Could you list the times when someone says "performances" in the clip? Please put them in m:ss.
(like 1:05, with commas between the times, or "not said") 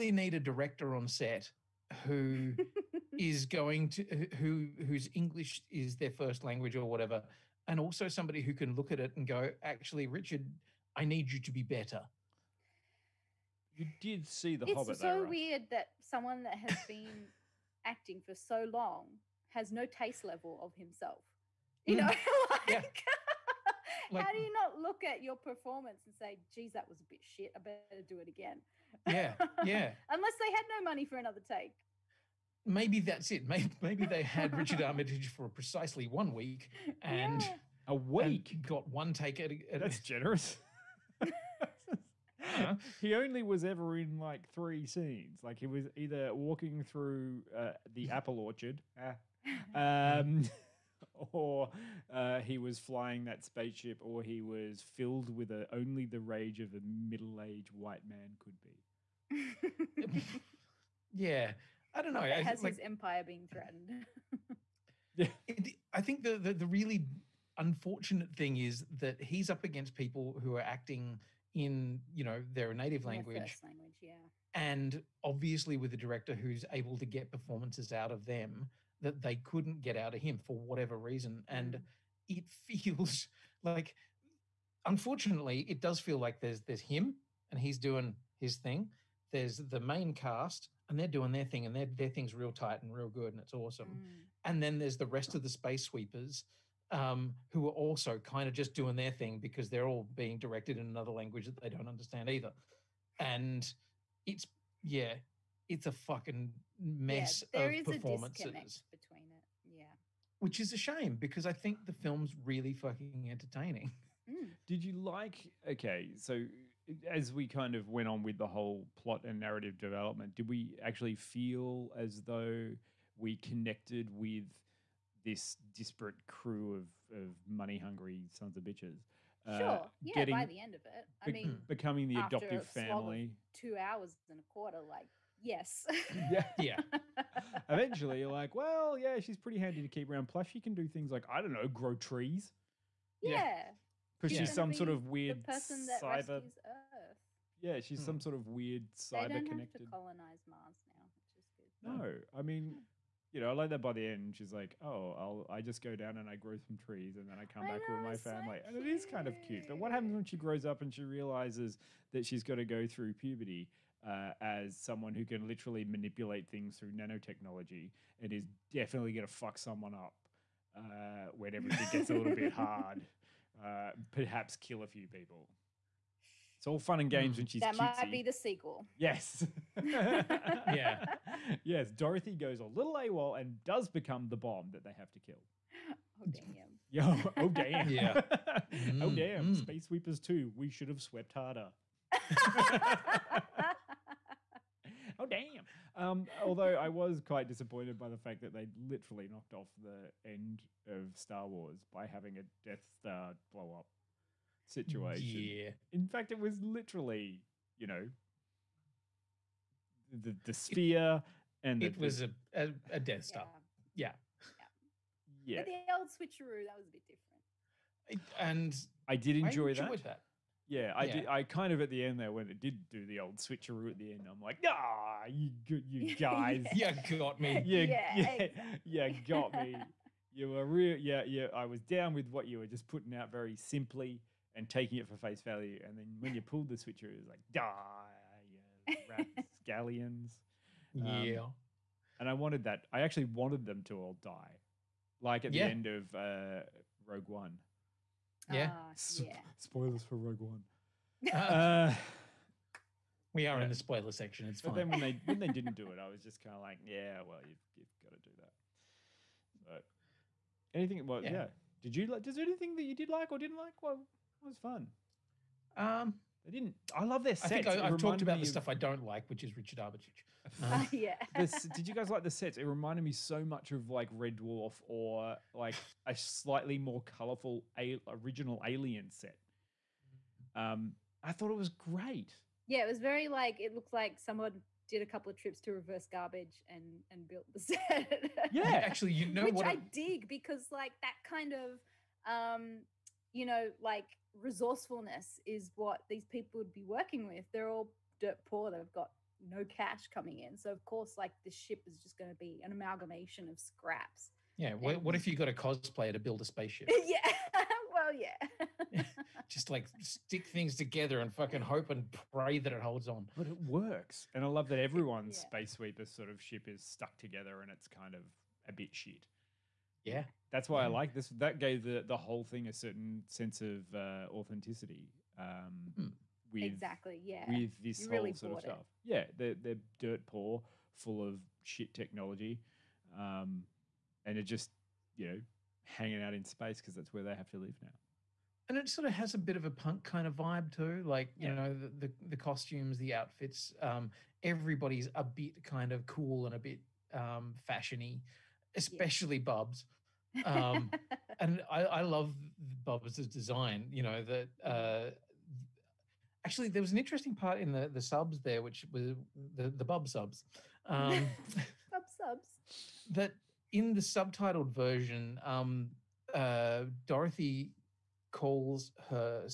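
0:25, 1:17, 1:47.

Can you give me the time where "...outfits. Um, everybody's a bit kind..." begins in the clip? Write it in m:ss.
5:43.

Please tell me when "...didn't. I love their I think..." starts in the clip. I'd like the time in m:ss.
4:26.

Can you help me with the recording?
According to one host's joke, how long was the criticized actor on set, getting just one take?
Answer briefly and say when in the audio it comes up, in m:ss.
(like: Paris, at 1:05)
a week, at 0:37.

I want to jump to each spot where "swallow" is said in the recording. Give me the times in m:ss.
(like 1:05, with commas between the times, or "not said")
not said.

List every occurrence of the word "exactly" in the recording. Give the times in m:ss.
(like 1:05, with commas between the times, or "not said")
3:48, 5:26.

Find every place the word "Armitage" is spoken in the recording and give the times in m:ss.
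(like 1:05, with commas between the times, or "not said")
0:34, 4:29.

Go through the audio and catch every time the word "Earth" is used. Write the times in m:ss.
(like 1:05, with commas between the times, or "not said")
2:26.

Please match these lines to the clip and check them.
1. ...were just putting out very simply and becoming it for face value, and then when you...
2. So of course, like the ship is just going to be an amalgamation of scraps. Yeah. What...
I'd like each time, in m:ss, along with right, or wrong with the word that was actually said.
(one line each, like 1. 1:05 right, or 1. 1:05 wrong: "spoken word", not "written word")
1. 3:52 wrong: "taking", not "becoming"
2. 5:00 right.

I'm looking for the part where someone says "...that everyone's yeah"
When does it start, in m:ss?
5:14.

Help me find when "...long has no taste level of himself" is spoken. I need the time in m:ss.
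0:18.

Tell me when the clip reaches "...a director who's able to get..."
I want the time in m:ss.
1:15.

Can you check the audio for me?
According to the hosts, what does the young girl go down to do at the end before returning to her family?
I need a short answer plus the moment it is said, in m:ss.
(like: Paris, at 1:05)
grow some trees, at 2:36.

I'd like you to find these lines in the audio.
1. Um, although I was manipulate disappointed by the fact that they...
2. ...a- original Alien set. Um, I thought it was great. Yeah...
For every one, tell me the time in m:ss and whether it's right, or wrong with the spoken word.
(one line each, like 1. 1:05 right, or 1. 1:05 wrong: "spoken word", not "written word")
1. 3:15 wrong: "quite", not "manipulate"
2. 4:37 right.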